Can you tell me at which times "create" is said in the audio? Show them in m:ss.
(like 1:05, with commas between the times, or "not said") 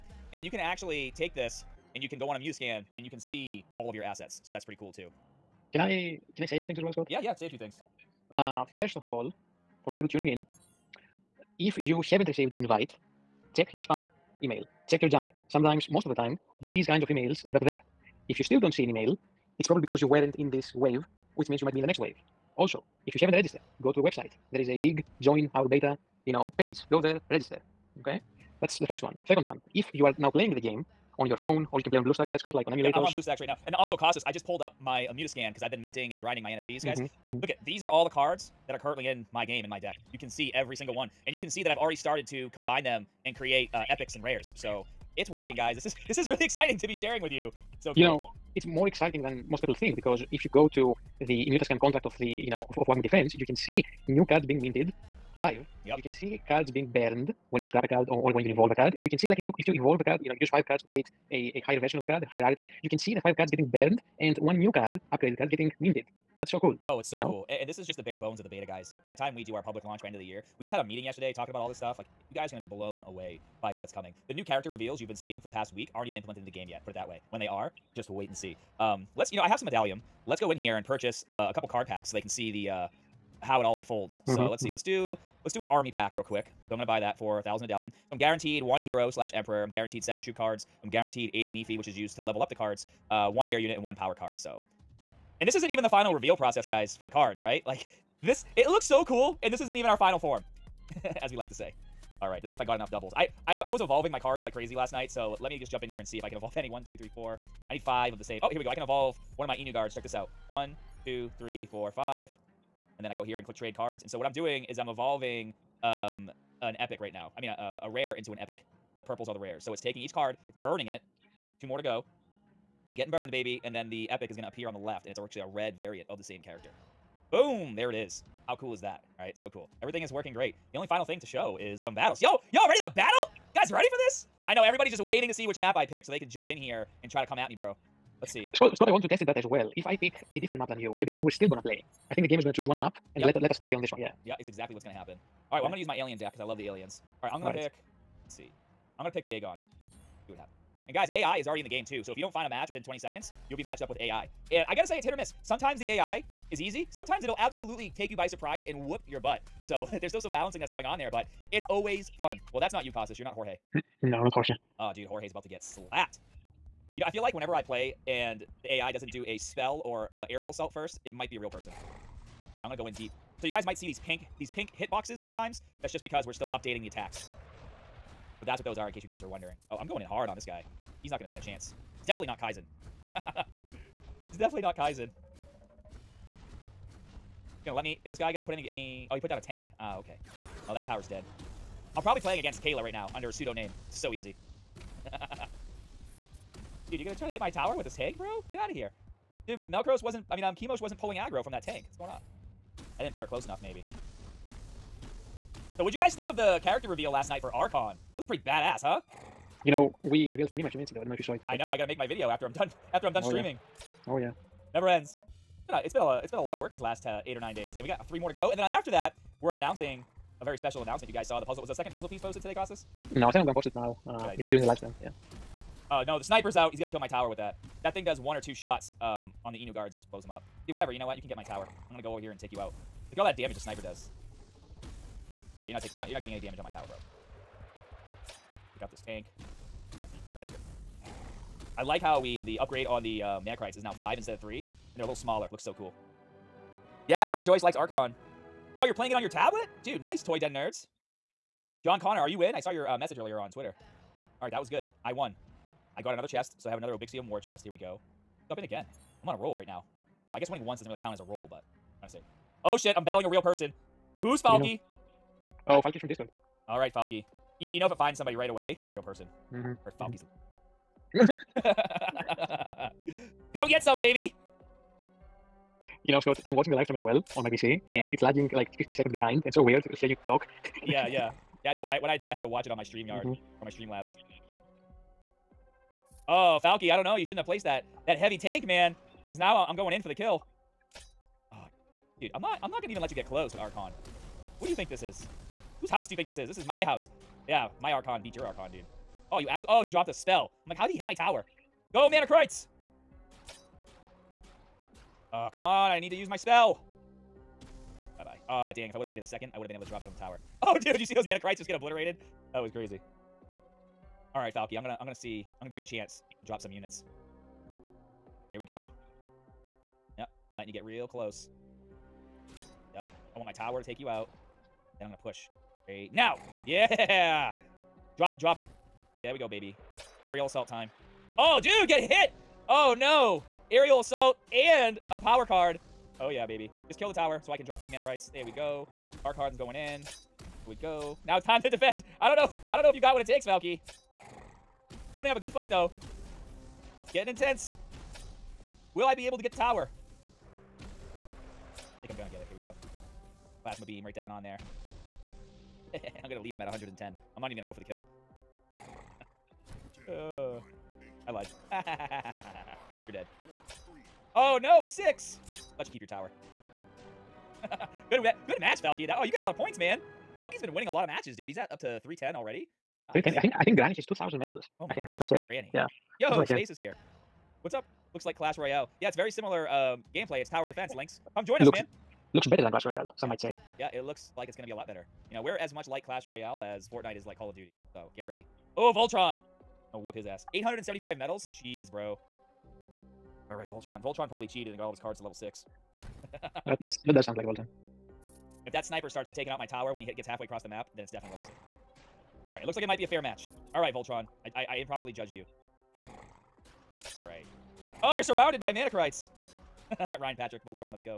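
0:43, 1:00.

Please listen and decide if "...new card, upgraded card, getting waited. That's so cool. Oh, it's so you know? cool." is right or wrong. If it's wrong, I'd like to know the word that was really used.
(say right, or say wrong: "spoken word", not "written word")
wrong: "minted", not "waited".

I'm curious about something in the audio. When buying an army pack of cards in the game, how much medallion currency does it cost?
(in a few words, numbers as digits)
1000.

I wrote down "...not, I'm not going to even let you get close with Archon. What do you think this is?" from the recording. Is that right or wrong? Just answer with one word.
right.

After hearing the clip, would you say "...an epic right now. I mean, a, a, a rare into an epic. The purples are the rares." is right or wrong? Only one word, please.
right.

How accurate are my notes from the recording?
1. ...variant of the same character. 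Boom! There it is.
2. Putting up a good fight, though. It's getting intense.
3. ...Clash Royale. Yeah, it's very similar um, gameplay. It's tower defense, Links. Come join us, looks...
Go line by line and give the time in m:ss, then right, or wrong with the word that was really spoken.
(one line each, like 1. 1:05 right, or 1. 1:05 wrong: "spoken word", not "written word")
1. 2:05 right
2. 5:45 right
3. 6:18 right.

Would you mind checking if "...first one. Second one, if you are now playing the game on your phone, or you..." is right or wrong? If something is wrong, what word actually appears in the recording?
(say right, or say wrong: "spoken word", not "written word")
right.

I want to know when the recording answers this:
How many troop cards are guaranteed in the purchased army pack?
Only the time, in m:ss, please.
1:30.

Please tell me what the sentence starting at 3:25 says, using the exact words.
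So what'd you guys think of the character reveal last night for Archon?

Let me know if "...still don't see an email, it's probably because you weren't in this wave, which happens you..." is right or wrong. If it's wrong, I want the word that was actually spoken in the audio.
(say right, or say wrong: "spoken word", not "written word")
wrong: "means", not "happens".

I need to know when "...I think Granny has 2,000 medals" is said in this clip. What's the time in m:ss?
6:13.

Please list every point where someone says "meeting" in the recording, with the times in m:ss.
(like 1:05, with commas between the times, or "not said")
1:10.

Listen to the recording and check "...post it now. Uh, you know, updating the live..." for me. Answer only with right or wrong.
wrong.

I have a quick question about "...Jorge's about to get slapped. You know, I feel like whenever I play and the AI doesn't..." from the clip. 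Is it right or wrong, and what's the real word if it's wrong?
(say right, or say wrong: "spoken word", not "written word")
right.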